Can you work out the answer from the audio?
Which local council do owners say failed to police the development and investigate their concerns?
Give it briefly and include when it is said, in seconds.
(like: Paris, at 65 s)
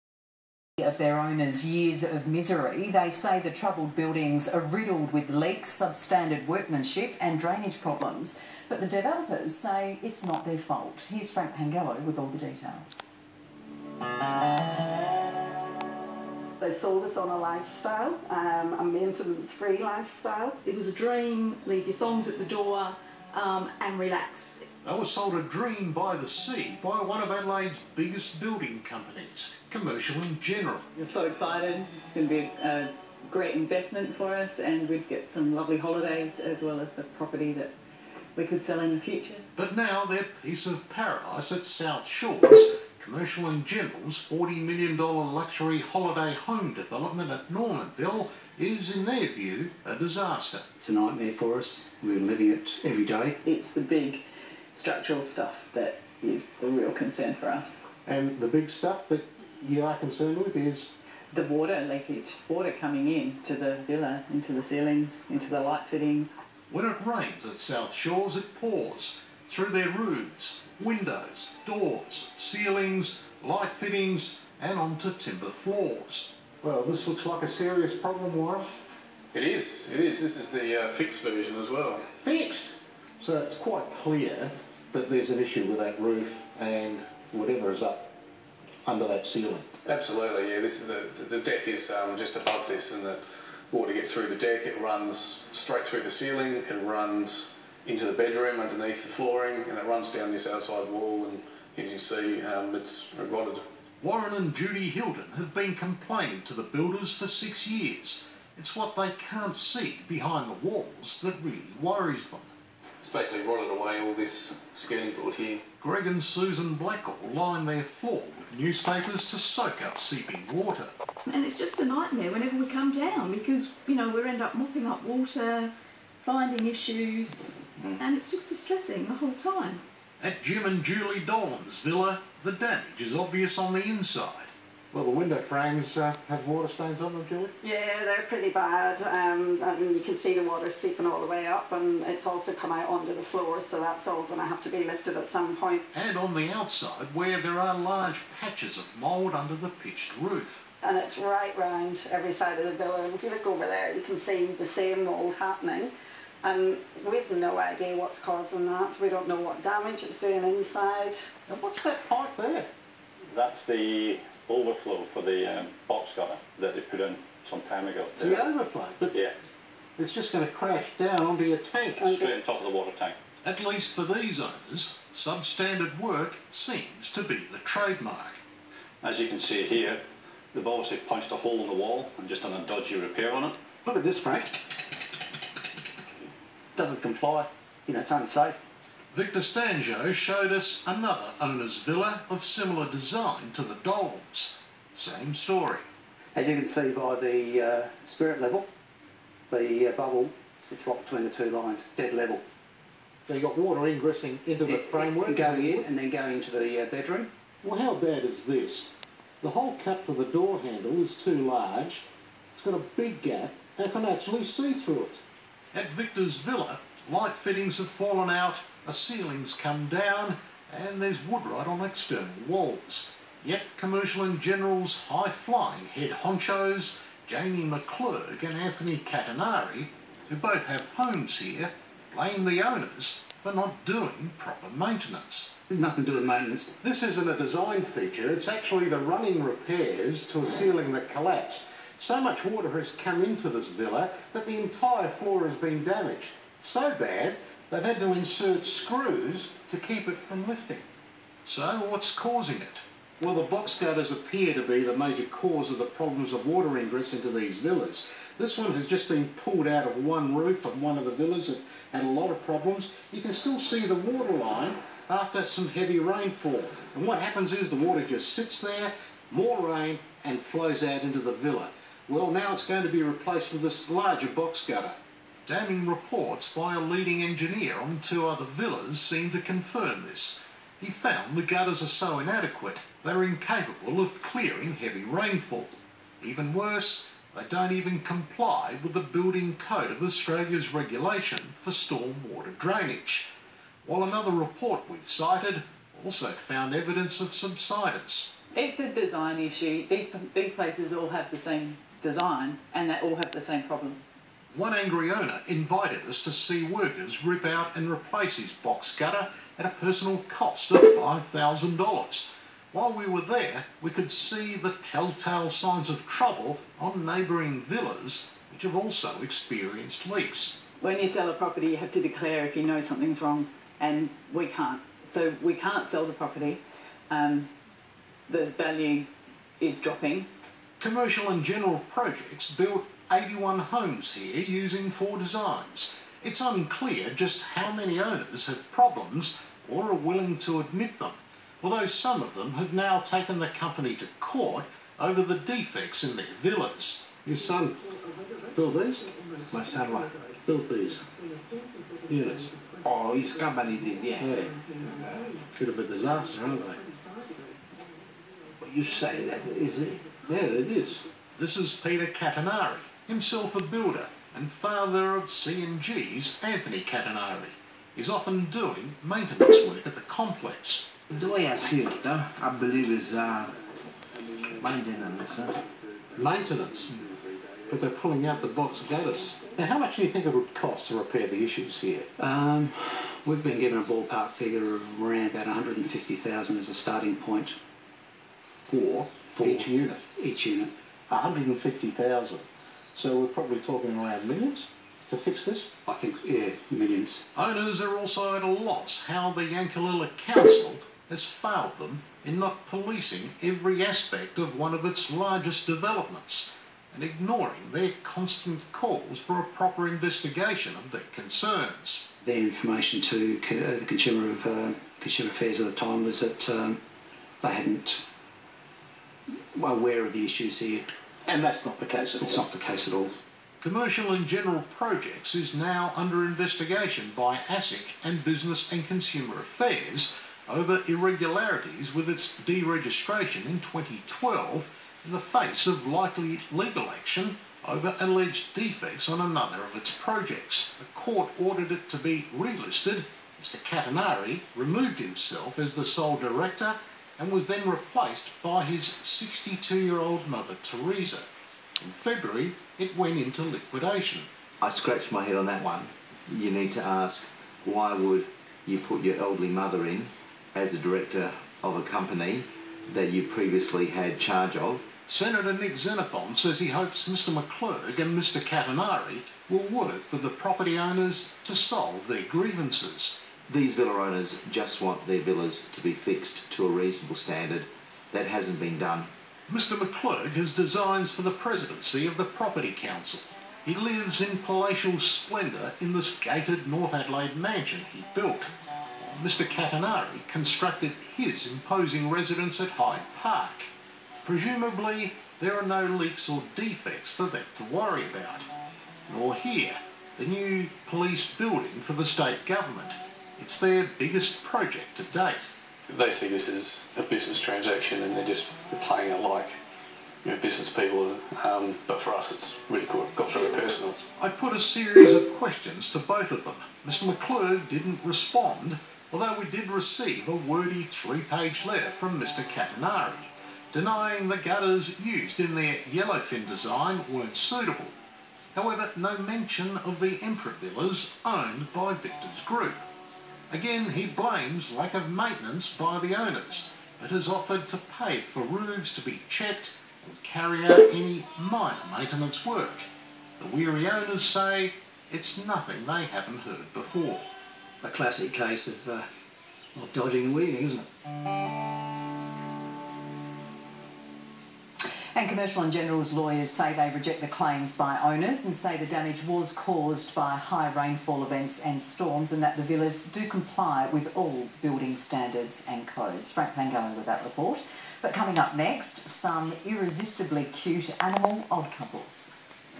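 Yankalilla Council, at 399 s.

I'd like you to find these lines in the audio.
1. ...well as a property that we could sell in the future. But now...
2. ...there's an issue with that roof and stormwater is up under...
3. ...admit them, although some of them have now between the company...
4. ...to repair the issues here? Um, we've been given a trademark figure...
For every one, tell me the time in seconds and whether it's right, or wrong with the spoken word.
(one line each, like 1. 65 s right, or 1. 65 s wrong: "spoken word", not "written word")
1. 36 s right
2. 85 s wrong: "whatever", not "stormwater"
3. 340 s wrong: "taken", not "between"
4. 380 s wrong: "ballpark", not "trademark".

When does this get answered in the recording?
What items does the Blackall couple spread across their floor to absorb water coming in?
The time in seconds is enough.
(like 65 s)
118 s.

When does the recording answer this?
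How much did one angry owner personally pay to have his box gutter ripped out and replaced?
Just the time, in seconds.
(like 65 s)
310 s.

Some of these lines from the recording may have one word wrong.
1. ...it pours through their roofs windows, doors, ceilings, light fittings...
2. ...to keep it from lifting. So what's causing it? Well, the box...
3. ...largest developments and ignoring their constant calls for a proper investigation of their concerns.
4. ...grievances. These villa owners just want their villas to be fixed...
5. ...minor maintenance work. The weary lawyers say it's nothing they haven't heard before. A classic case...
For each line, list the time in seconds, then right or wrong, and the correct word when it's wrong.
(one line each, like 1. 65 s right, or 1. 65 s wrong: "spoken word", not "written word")
1. 68 s right
2. 249 s right
3. 405 s right
4. 472 s right
5. 541 s wrong: "owners", not "lawyers".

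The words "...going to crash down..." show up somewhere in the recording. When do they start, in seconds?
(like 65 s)
170 s.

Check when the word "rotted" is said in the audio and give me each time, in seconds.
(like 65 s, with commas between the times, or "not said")
103 s, 113 s.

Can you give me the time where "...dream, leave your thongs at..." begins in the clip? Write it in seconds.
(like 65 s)
20 s.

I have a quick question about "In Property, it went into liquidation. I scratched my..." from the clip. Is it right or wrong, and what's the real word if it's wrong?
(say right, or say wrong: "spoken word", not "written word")
wrong: "February", not "Property".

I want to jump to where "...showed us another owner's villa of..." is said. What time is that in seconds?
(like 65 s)
190 s.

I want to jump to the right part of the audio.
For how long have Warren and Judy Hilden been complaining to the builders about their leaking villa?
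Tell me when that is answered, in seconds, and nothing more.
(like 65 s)
107 s.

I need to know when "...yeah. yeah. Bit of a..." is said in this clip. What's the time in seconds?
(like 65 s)
354 s.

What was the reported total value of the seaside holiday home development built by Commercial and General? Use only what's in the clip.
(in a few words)
$40 million.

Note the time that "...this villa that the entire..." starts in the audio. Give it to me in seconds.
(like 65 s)
243 s.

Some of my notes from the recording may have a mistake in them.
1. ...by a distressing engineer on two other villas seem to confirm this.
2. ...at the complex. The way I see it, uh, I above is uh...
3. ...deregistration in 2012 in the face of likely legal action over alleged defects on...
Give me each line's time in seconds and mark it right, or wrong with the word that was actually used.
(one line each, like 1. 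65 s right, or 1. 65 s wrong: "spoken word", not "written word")
1. 276 s wrong: "leading", not "distressing"
2. 369 s wrong: "believe", not "above"
3. 432 s right.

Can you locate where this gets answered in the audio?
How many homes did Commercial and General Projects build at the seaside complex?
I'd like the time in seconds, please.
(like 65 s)
333 s.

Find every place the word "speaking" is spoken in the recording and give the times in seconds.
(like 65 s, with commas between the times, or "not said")
not said.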